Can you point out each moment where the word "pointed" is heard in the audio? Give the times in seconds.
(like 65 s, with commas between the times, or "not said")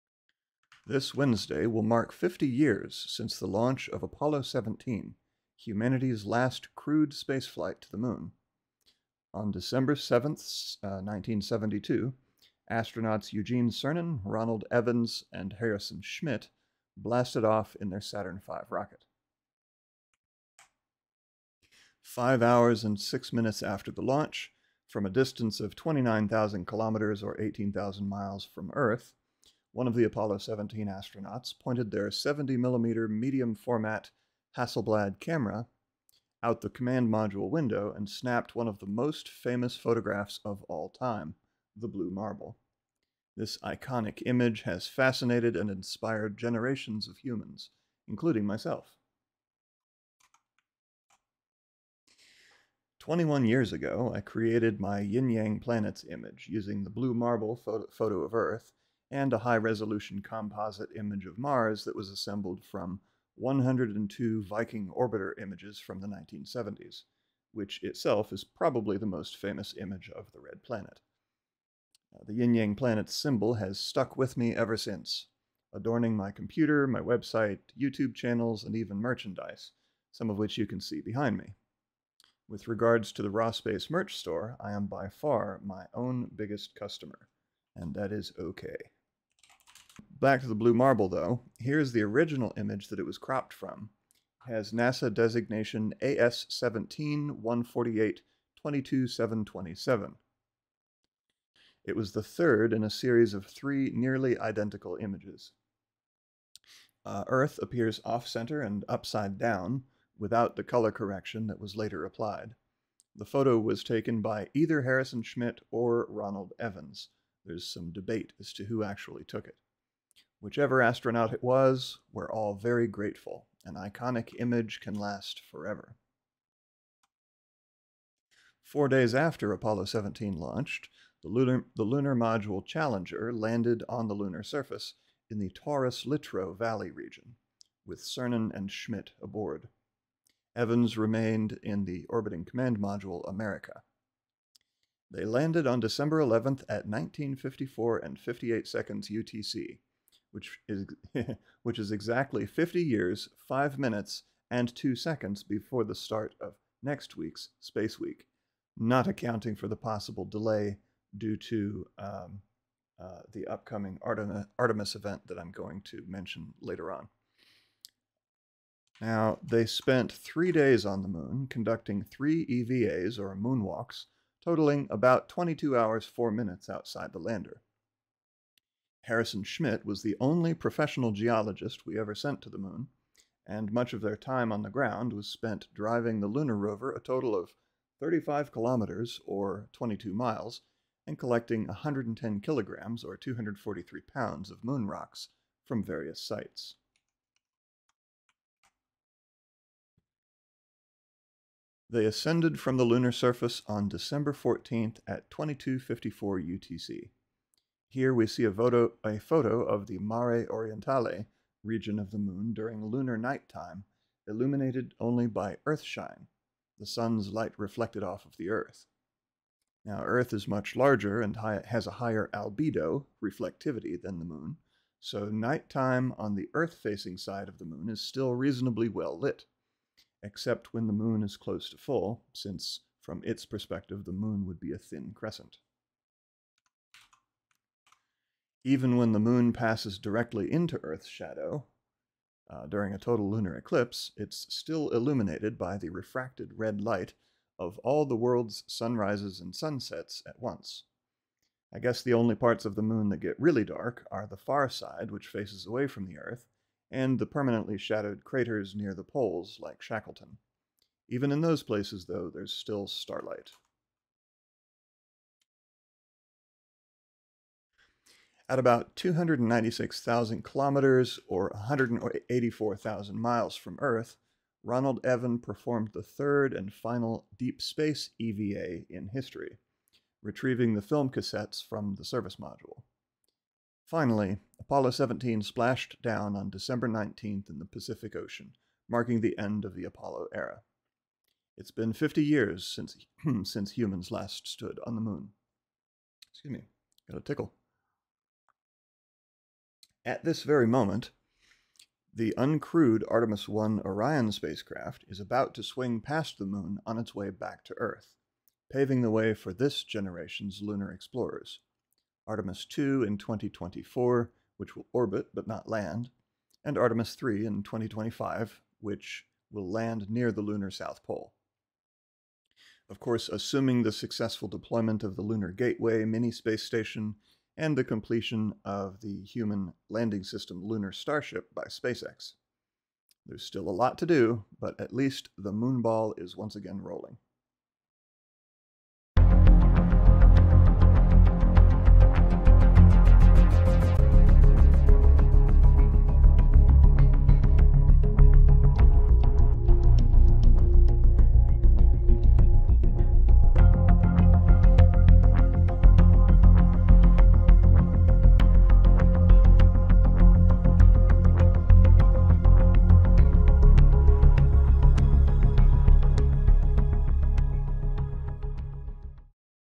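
31 s.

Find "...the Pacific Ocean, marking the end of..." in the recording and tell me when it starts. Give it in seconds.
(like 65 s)
287 s.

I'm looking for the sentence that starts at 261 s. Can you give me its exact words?
Even in those places, though, there's still starlight.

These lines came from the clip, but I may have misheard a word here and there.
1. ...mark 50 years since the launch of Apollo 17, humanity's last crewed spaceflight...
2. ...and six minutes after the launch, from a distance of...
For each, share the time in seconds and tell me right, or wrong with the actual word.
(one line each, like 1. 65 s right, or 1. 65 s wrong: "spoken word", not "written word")
1. 1 s right
2. 22 s right.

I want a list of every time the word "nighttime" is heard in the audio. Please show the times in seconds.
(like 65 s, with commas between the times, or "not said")
213 s, 225 s.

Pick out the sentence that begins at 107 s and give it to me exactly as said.
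Uh, Earth appears off center and upside down without the color correction that was later applied.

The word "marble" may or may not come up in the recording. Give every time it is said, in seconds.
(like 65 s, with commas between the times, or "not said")
42 s, 57 s, 90 s.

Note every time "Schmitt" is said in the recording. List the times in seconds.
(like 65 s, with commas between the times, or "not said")
16 s, 115 s, 138 s, 179 s.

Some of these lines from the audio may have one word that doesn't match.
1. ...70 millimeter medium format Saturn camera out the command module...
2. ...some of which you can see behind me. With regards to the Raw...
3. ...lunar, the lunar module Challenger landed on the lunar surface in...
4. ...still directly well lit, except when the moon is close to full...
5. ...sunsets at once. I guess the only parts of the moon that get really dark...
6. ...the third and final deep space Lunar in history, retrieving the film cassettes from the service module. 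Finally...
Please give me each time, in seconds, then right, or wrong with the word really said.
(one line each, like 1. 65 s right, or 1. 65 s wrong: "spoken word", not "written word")
1. 32 s wrong: "Hasselblad", not "Saturn"
2. 80 s right
3. 131 s right
4. 227 s wrong: "reasonably", not "directly"
5. 249 s right
6. 275 s wrong: "EVA", not "Lunar".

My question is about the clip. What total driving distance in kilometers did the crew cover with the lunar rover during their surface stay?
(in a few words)
35 kilometers.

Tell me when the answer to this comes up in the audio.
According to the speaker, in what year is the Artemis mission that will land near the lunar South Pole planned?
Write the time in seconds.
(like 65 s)
317 s.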